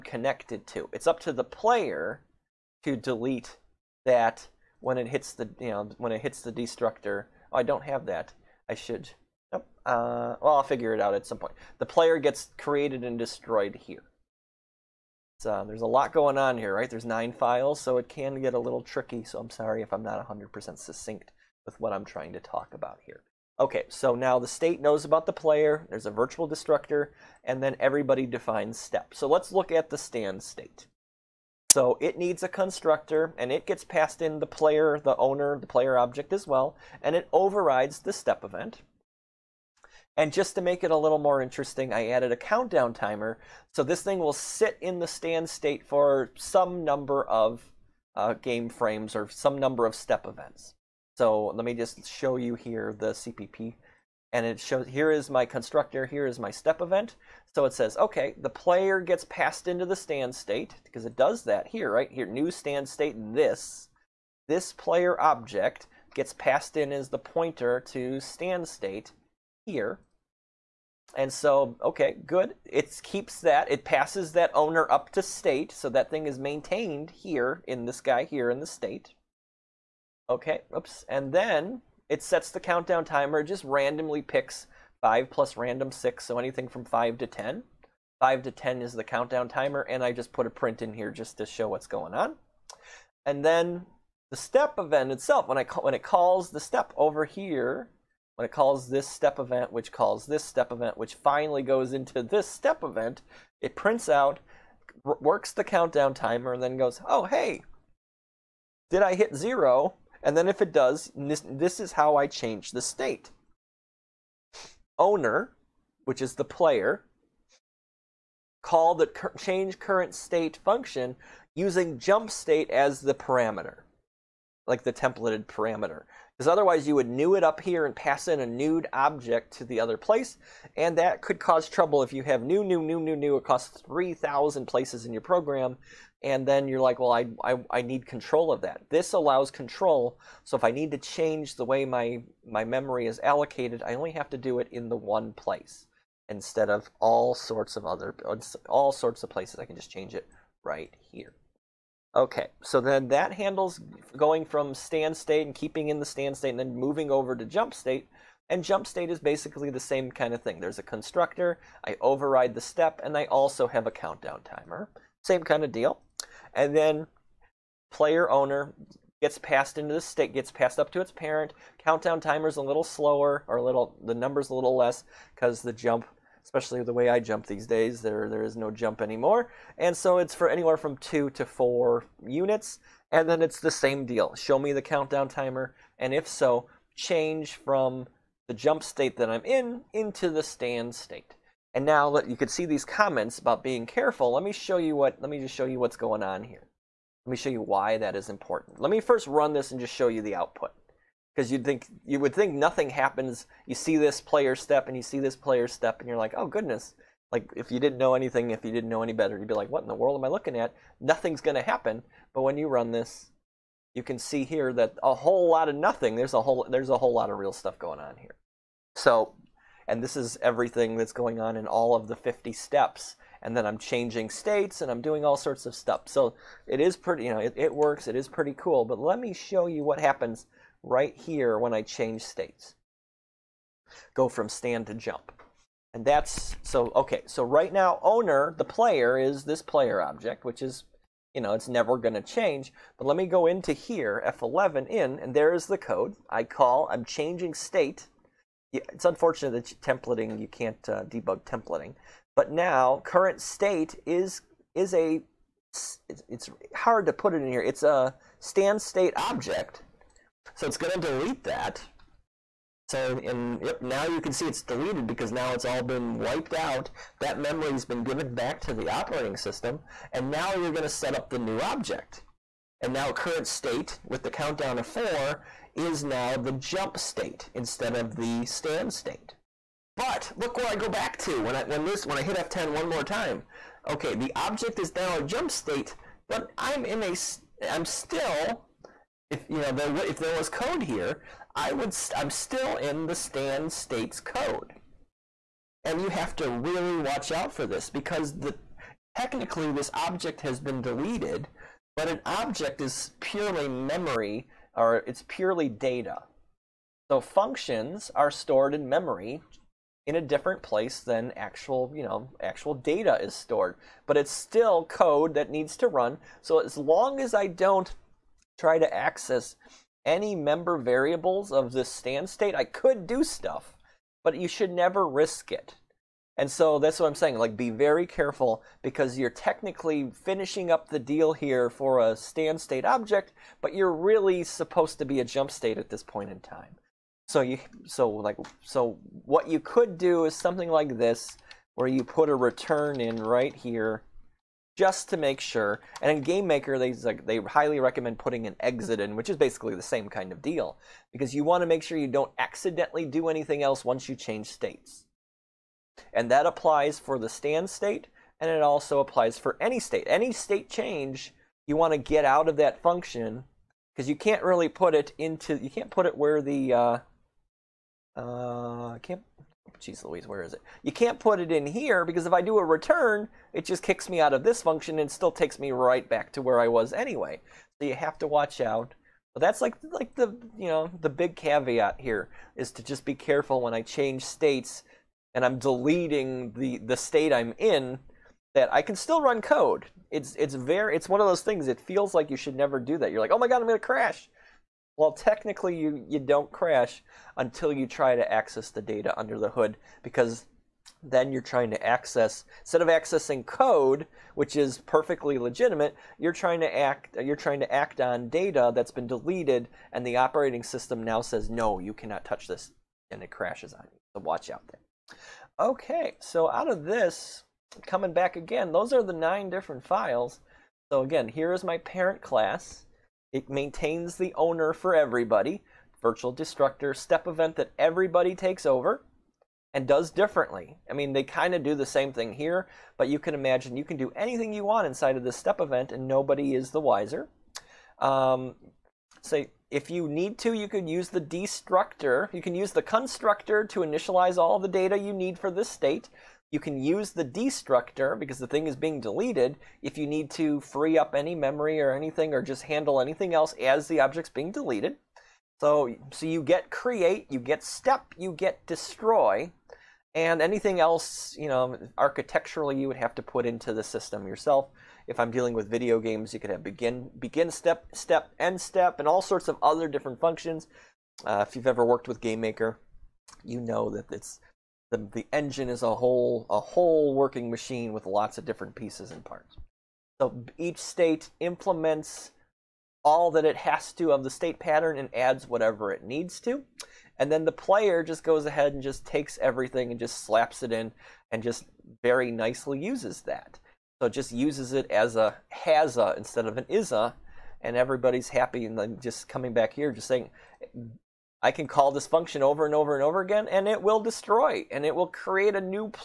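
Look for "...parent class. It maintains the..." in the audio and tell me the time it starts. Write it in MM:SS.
07:01.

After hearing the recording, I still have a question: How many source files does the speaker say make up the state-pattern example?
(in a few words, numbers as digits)
9.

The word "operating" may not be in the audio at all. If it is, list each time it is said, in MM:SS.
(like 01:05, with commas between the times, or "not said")
04:28, 06:50.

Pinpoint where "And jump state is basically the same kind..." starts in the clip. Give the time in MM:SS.
02:38.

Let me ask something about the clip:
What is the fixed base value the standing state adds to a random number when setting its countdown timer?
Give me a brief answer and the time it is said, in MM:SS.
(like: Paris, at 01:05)
5, at 01:25.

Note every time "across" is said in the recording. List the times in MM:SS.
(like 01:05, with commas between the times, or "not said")
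02:13.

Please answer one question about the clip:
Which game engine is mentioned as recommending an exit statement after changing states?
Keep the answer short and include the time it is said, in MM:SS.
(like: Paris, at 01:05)
GameMaker, at 05:46.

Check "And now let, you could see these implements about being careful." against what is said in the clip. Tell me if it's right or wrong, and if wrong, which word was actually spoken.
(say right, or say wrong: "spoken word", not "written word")
wrong: "comments", not "implements".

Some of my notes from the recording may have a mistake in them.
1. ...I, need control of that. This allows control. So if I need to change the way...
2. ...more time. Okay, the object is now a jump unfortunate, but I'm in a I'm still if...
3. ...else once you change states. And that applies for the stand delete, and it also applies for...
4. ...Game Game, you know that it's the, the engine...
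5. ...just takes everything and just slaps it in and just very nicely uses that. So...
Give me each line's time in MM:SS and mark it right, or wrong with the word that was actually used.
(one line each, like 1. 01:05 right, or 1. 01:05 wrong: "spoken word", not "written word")
1. 02:17 right
2. 04:42 wrong: "state", not "unfortunate"
3. 05:53 wrong: "state", not "delete"
4. 07:52 wrong: "Maker", not "Game"
5. 08:08 right.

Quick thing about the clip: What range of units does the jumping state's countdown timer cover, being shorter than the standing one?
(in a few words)
2 to 4.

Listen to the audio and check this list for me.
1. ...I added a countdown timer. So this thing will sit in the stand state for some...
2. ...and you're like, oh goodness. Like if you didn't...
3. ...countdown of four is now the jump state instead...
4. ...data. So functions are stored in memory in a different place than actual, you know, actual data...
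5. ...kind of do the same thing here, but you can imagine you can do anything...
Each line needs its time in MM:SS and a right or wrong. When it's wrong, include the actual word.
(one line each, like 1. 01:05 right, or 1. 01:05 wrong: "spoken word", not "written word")
1. 00:41 right
2. 03:25 right
3. 04:34 right
4. 05:05 right
5. 07:11 right.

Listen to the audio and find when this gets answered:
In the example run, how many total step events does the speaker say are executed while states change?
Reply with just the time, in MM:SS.
03:42.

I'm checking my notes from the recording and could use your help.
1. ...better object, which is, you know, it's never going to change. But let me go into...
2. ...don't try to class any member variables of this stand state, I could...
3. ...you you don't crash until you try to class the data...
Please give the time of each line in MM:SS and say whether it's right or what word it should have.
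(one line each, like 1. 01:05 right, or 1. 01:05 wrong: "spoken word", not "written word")
1. 03:59 wrong: "player", not "better"
2. 05:17 wrong: "access", not "class"
3. 06:35 wrong: "access", not "class".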